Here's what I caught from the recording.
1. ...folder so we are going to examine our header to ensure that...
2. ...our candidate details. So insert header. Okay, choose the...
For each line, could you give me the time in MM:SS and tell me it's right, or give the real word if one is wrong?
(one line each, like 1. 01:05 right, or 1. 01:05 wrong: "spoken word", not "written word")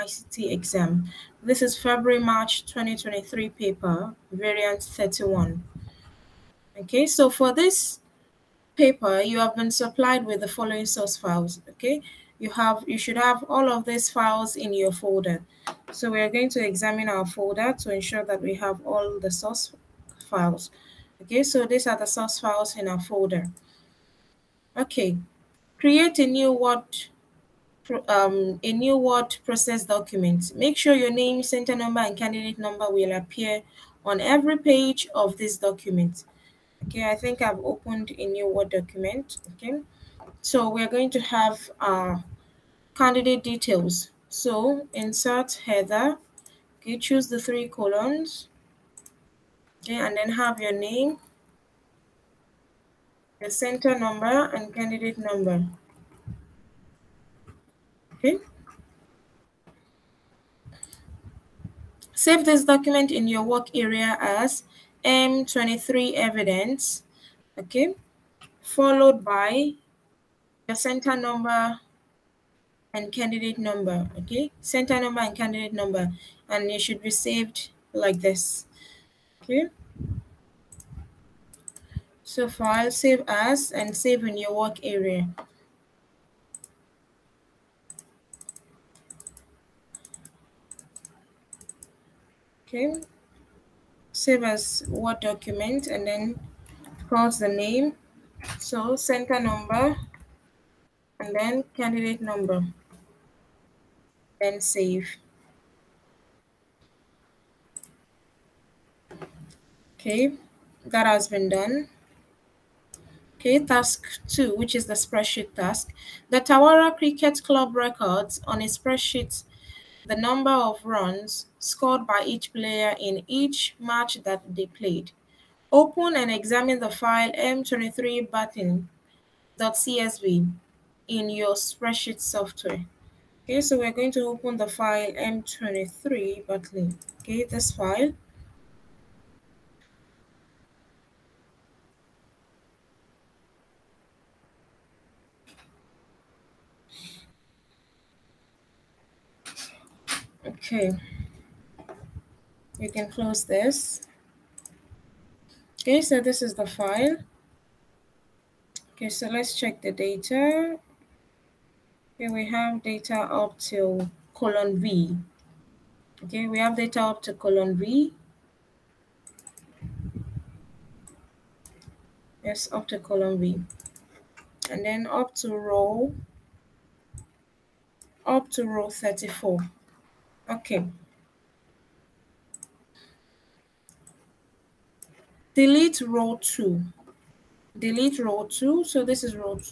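1. 00:14 wrong: "folder", not "header"
2. 00:41 right.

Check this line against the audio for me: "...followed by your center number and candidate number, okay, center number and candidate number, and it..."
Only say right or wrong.
right.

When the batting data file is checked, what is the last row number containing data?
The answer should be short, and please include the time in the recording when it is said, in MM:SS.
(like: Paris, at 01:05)
34, at 02:58.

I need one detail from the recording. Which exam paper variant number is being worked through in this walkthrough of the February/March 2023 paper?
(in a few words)
31.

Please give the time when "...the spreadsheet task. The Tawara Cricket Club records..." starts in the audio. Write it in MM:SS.
01:54.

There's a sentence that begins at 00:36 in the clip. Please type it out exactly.
Okay, I think I've opened a new Word document.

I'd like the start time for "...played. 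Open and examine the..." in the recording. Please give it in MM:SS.
02:04.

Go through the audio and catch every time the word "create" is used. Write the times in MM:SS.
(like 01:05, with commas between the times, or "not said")
00:25.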